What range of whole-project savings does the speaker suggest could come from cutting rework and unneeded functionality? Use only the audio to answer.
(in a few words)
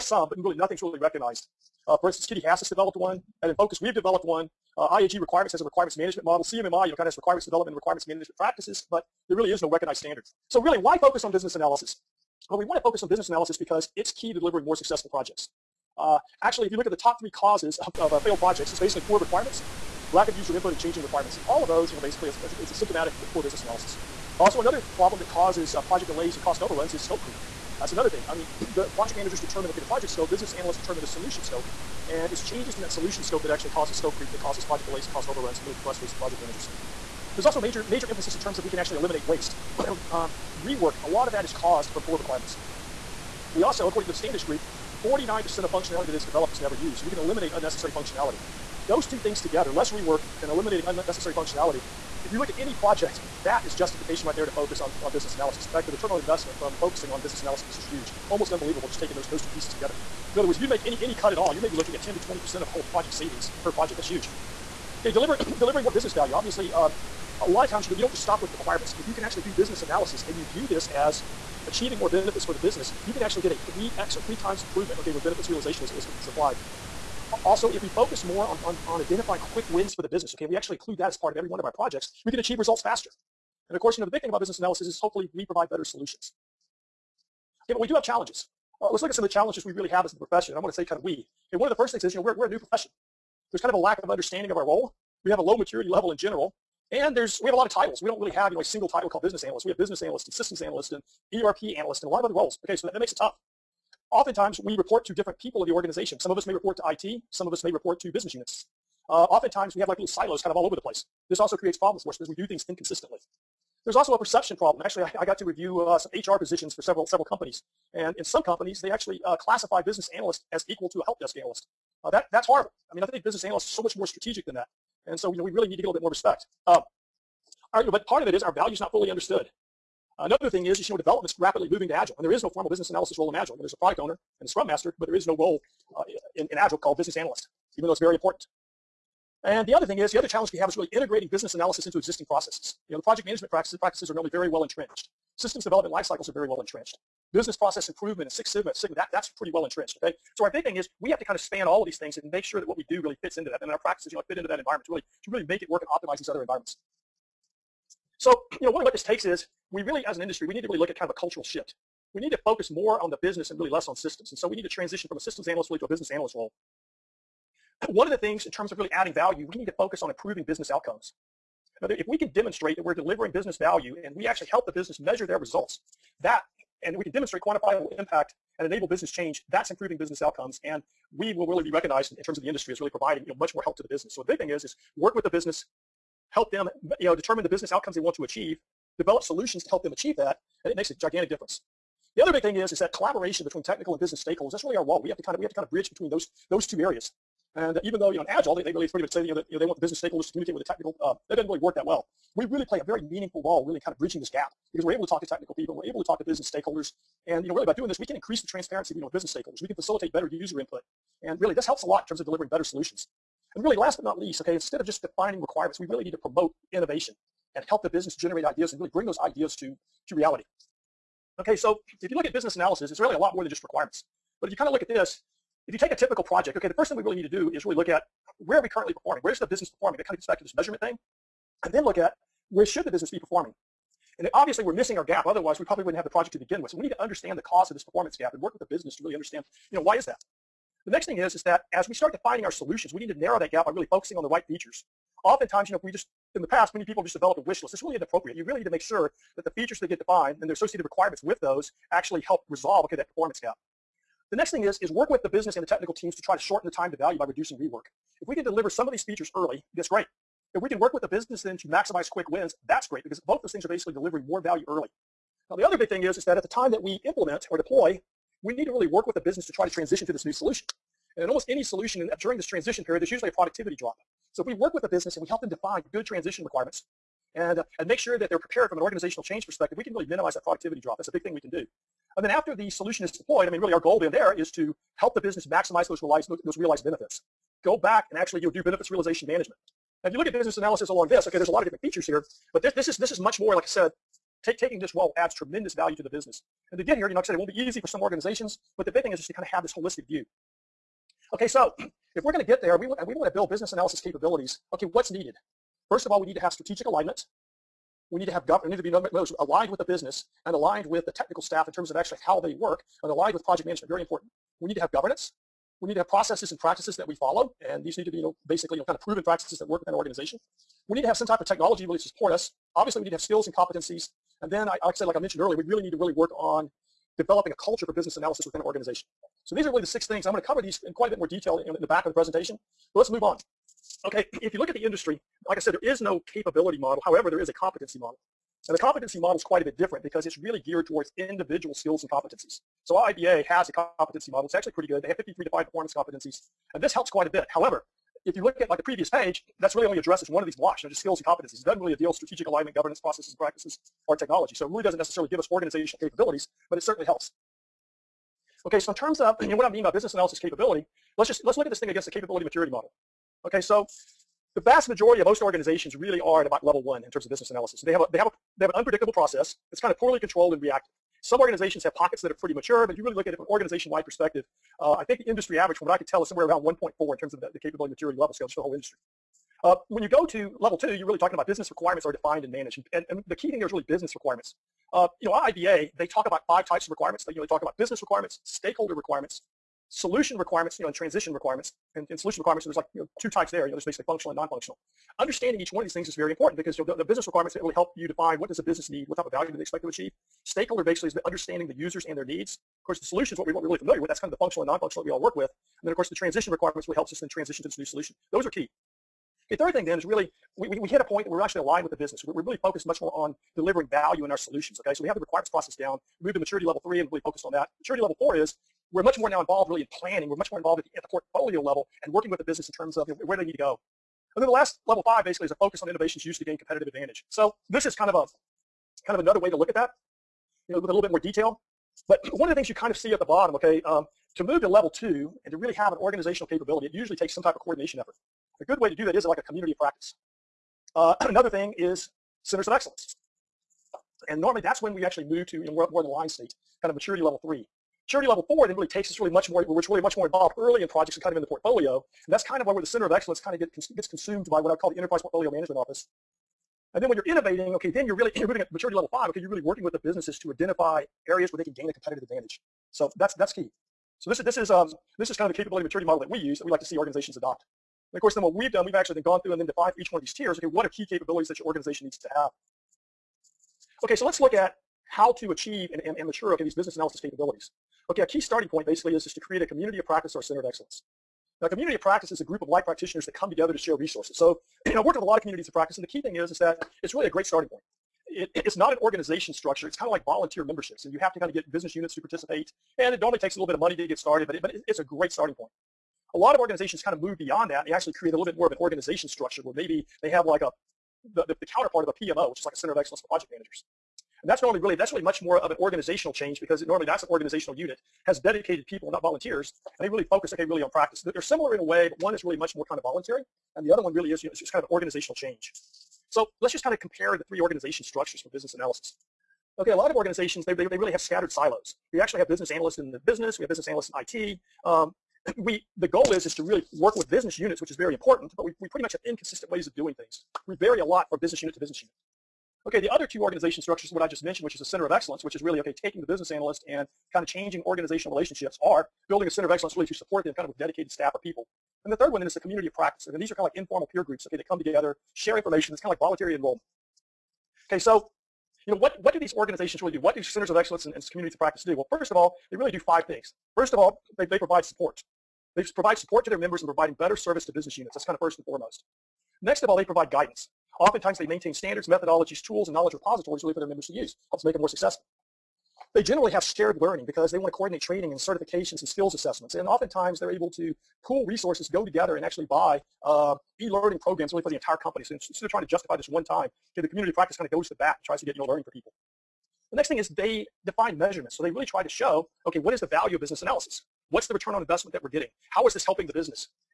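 10 to 20%.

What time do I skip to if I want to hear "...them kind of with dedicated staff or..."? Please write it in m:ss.
9:00.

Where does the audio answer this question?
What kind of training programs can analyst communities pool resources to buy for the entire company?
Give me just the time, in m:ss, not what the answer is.
9:33.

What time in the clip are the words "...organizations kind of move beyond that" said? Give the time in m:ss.
8:16.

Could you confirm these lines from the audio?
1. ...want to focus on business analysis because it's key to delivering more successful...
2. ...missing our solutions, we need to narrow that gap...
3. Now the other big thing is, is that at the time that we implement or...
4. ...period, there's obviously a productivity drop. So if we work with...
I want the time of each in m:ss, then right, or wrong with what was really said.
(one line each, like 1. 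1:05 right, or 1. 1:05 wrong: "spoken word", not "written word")
1. 0:12 right
2. 4:02 wrong: "defining", not "missing"
3. 4:25 right
4. 4:32 wrong: "usually", not "obviously".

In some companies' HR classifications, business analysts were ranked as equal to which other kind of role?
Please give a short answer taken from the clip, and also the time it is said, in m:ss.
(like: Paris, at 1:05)
help desk analyst, at 2:01.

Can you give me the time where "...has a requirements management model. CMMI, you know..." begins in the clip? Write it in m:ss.
0:05.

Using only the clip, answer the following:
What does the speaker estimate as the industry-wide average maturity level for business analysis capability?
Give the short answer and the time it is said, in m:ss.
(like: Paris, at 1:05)
1.4, at 6:16.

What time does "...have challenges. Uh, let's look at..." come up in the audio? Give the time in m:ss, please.
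1:27.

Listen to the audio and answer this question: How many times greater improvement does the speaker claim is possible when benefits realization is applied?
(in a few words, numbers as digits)
3x.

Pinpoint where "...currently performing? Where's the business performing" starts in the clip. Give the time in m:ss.
3:48.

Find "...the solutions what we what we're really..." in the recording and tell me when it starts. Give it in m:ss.
6:42.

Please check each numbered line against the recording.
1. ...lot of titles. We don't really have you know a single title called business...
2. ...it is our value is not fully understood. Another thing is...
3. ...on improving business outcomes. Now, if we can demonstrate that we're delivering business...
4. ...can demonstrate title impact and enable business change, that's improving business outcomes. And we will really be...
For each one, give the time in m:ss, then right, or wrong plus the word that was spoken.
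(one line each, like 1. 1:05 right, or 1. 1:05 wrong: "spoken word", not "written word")
1. 1:37 right
2. 2:08 right
3. 2:50 right
4. 2:57 wrong: "quantifiable", not "title".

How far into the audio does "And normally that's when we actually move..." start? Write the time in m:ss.
7:24.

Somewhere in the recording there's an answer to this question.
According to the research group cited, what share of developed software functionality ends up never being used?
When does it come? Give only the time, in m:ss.
0:45.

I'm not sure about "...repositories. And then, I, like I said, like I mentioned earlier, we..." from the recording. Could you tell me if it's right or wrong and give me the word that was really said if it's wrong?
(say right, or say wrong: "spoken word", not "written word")
wrong: "competencies", not "repositories".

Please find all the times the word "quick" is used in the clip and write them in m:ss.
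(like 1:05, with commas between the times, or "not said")
1:19, 4:22.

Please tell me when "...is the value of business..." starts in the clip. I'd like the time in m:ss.
9:42.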